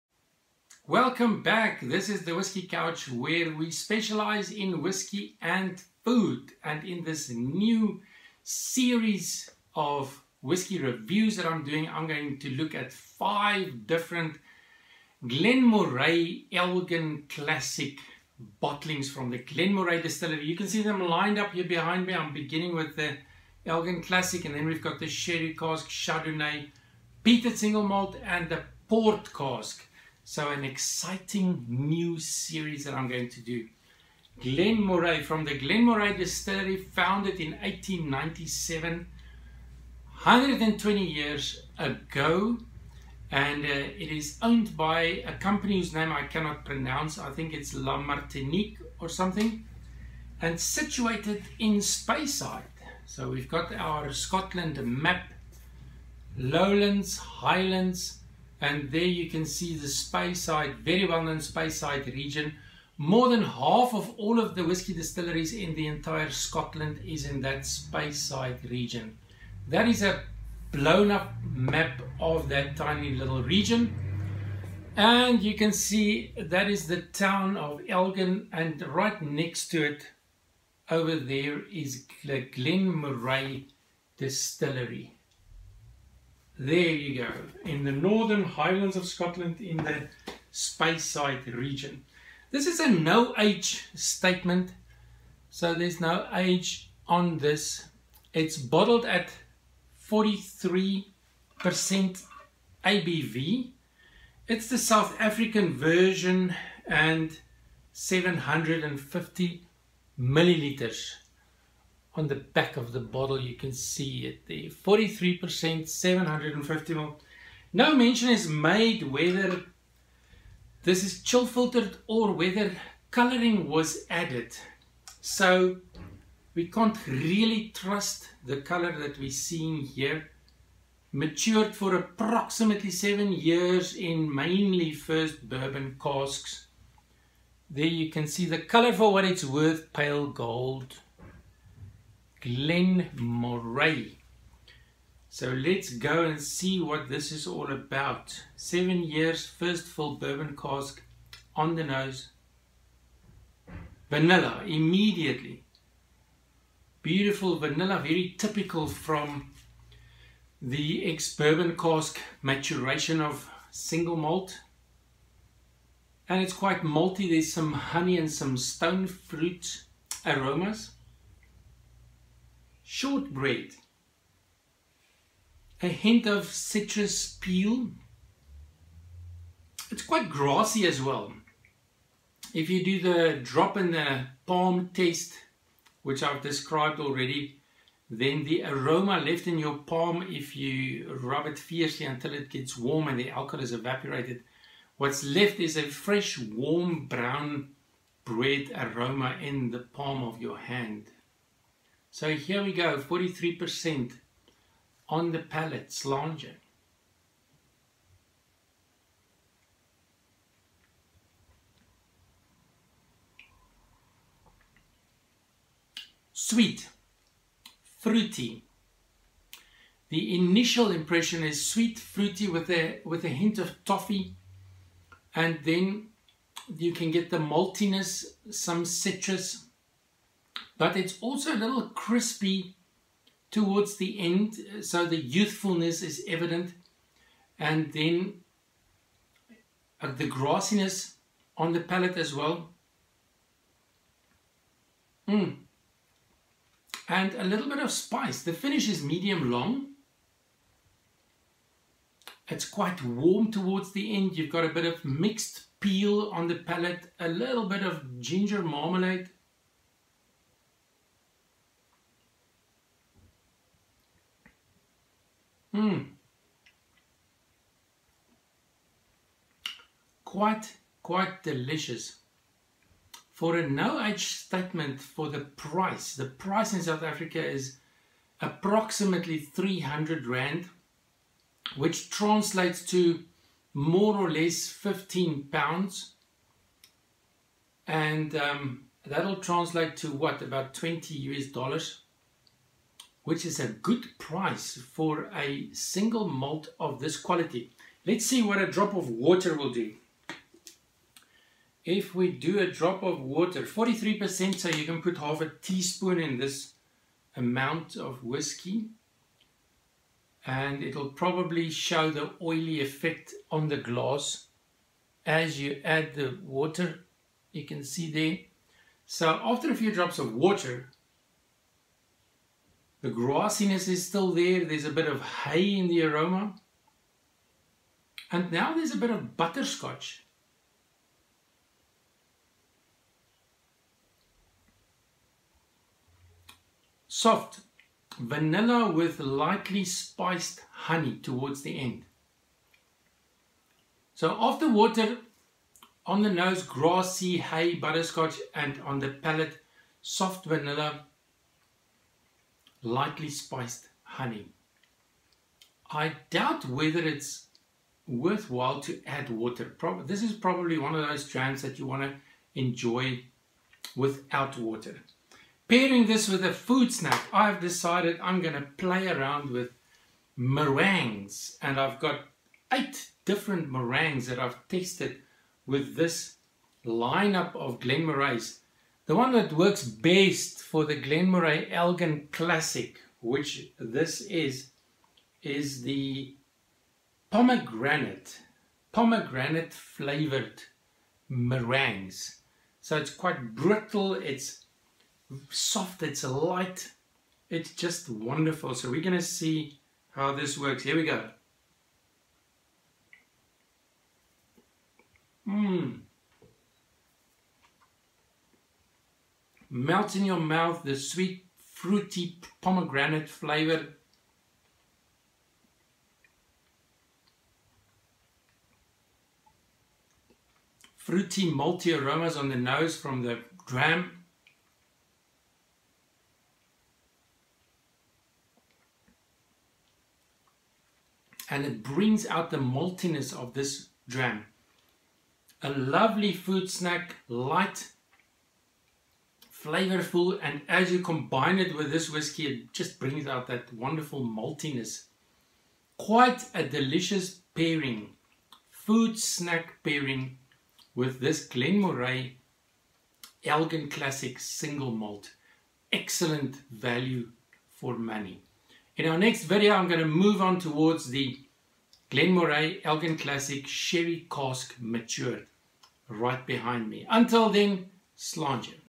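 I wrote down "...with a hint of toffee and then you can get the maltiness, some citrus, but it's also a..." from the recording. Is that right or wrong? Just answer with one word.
right.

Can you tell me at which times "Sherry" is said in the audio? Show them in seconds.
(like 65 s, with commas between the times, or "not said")
25 s, 463 s.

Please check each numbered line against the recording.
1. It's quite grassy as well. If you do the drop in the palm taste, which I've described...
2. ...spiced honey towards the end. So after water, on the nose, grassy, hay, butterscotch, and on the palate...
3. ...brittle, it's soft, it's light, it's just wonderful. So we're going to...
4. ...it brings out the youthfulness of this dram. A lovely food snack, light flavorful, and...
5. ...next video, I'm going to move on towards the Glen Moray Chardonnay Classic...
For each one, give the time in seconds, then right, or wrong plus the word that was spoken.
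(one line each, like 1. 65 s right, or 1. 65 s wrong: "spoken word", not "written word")
1. 179 s right
2. 339 s right
3. 393 s right
4. 431 s wrong: "maltiness", not "youthfulness"
5. 459 s wrong: "Elgin", not "Chardonnay".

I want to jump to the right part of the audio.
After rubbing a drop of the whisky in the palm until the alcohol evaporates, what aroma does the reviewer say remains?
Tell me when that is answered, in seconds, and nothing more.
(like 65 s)
196 s.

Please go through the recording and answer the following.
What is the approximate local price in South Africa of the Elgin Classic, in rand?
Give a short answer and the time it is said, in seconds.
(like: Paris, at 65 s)
300 rand, at 279 s.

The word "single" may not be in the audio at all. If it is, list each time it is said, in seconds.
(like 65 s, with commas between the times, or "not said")
27 s, 163 s, 295 s, 454 s.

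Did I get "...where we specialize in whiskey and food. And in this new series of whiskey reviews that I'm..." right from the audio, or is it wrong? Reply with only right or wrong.
right.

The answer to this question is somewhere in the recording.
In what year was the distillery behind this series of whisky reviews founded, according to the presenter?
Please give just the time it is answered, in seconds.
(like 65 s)
37 s.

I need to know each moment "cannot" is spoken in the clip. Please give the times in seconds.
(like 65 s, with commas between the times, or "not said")
46 s.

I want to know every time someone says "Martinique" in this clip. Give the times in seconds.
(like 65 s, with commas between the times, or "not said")
47 s.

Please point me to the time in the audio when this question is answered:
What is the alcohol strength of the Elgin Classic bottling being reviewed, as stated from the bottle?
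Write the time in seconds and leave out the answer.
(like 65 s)
100 s.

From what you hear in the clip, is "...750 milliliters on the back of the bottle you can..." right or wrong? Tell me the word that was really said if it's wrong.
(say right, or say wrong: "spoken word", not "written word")
right.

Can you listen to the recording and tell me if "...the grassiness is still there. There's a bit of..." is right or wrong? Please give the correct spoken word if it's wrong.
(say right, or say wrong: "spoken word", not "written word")
right.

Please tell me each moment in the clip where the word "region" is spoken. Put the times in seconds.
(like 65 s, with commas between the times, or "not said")
62 s, 68 s, 73 s, 91 s.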